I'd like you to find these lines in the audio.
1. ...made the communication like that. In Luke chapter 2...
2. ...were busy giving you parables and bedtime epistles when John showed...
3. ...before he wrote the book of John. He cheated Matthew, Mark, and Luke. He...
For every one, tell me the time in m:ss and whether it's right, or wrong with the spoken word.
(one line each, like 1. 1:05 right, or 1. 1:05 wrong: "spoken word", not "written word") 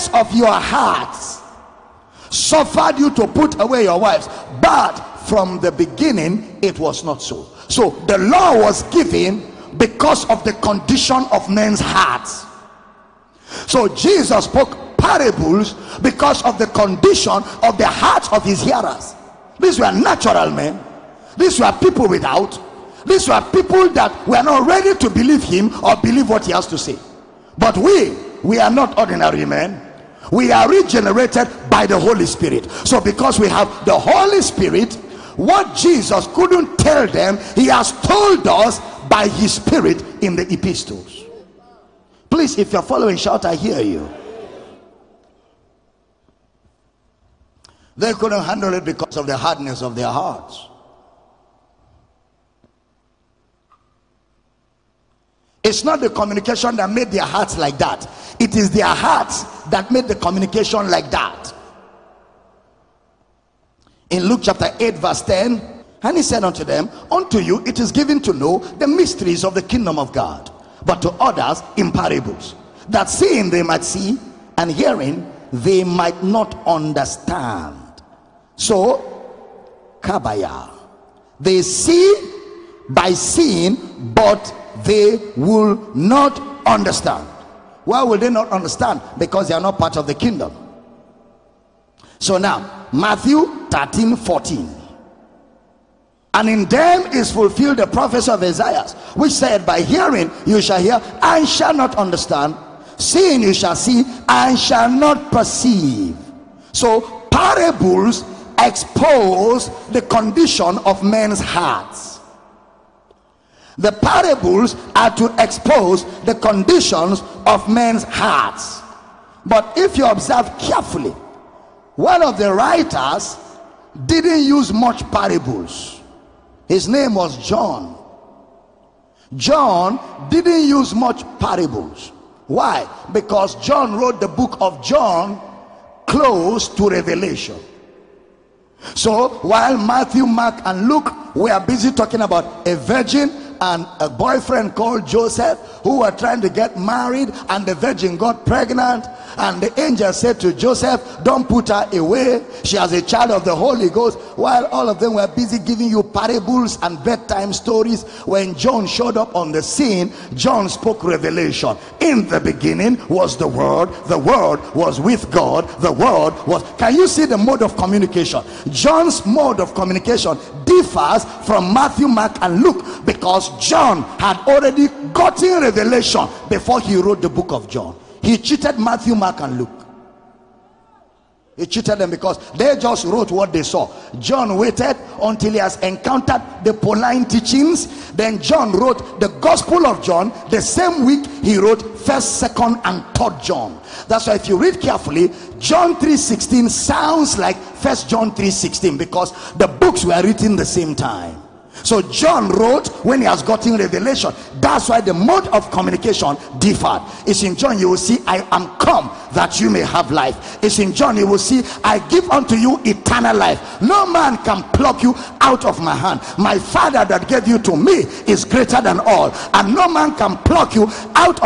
1. 0:59 wrong: "8", not "2"
2. 2:35 wrong: "stories", not "epistles"
3. 2:56 right.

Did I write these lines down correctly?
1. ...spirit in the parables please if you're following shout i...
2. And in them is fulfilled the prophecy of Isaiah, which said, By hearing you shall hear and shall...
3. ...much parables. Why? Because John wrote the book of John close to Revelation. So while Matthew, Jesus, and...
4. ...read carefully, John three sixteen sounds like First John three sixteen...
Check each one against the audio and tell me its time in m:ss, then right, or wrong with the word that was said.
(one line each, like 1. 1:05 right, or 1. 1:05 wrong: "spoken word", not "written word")
1. 0:39 wrong: "epistles", not "parables"
2. 1:36 right
3. 2:10 wrong: "Mark", not "Jesus"
4. 3:14 right.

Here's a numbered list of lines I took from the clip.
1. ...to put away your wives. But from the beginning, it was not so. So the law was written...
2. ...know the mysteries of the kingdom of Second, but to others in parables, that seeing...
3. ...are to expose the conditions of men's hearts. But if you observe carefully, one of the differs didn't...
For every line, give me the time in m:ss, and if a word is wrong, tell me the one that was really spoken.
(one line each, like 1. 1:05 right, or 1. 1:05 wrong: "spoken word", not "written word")
1. 0:03 wrong: "given", not "written"
2. 1:08 wrong: "God", not "Second"
3. 1:54 wrong: "writers", not "differs".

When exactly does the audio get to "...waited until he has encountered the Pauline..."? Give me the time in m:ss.
3:04.